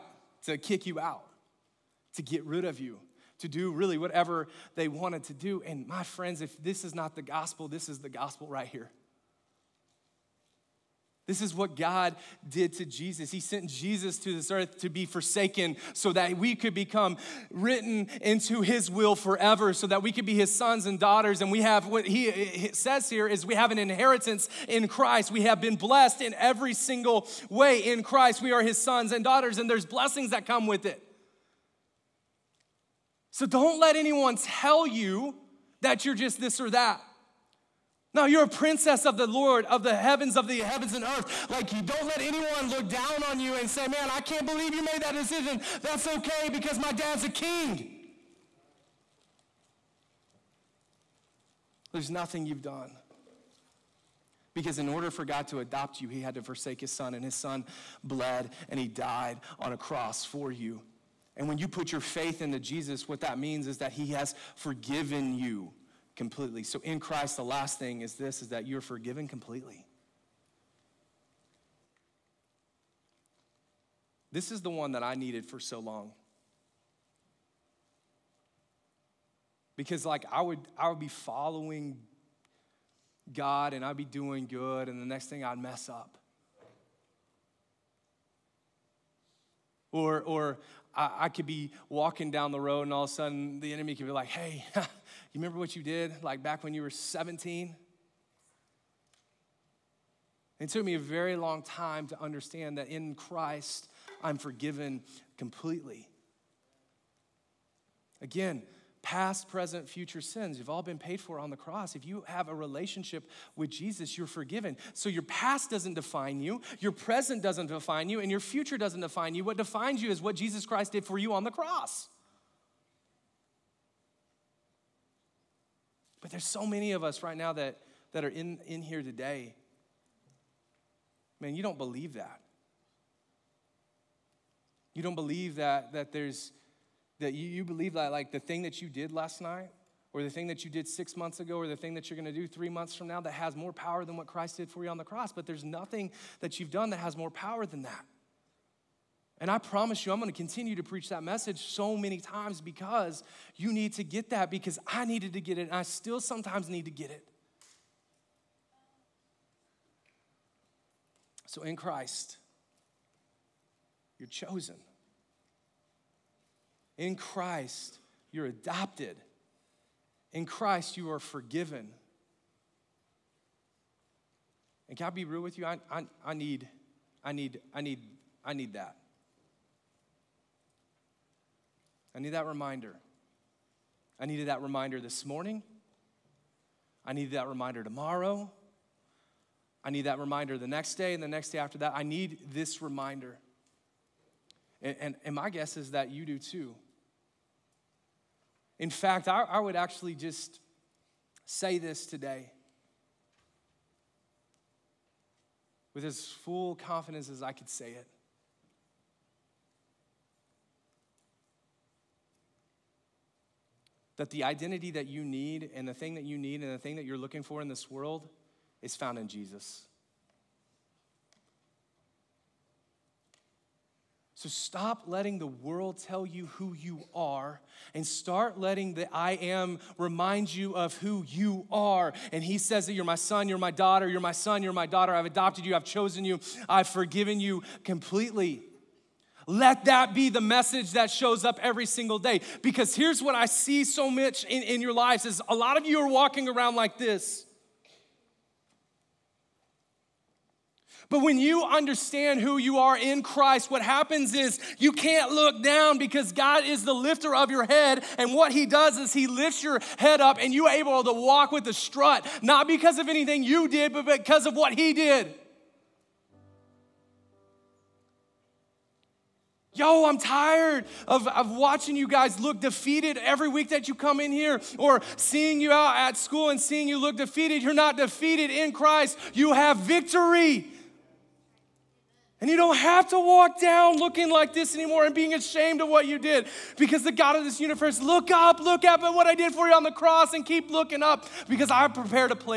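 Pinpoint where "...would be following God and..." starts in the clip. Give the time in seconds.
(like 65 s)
80 s.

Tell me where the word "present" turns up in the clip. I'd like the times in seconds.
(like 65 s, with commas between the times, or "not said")
109 s, 116 s.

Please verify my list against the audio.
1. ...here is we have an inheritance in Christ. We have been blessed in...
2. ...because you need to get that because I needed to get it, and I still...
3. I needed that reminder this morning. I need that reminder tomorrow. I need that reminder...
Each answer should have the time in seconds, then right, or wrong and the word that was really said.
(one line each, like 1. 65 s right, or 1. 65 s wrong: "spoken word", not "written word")
1. 23 s right
2. 152 s right
3. 184 s right.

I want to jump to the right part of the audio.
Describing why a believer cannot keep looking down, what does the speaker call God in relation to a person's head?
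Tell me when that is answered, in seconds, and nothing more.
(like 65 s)
256 s.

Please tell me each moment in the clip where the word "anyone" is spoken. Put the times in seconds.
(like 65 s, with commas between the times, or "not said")
33 s, 42 s.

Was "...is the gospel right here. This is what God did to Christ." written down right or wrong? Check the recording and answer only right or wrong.
wrong.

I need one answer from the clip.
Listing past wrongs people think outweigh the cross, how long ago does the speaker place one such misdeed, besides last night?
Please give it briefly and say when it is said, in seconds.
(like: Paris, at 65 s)
6 months ago, at 140 s.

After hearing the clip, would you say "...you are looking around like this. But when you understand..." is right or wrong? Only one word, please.
wrong.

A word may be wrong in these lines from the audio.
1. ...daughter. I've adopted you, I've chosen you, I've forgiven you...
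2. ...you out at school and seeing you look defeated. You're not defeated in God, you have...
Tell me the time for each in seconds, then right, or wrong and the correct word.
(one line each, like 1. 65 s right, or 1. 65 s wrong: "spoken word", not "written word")
1. 234 s right
2. 275 s wrong: "Christ", not "God".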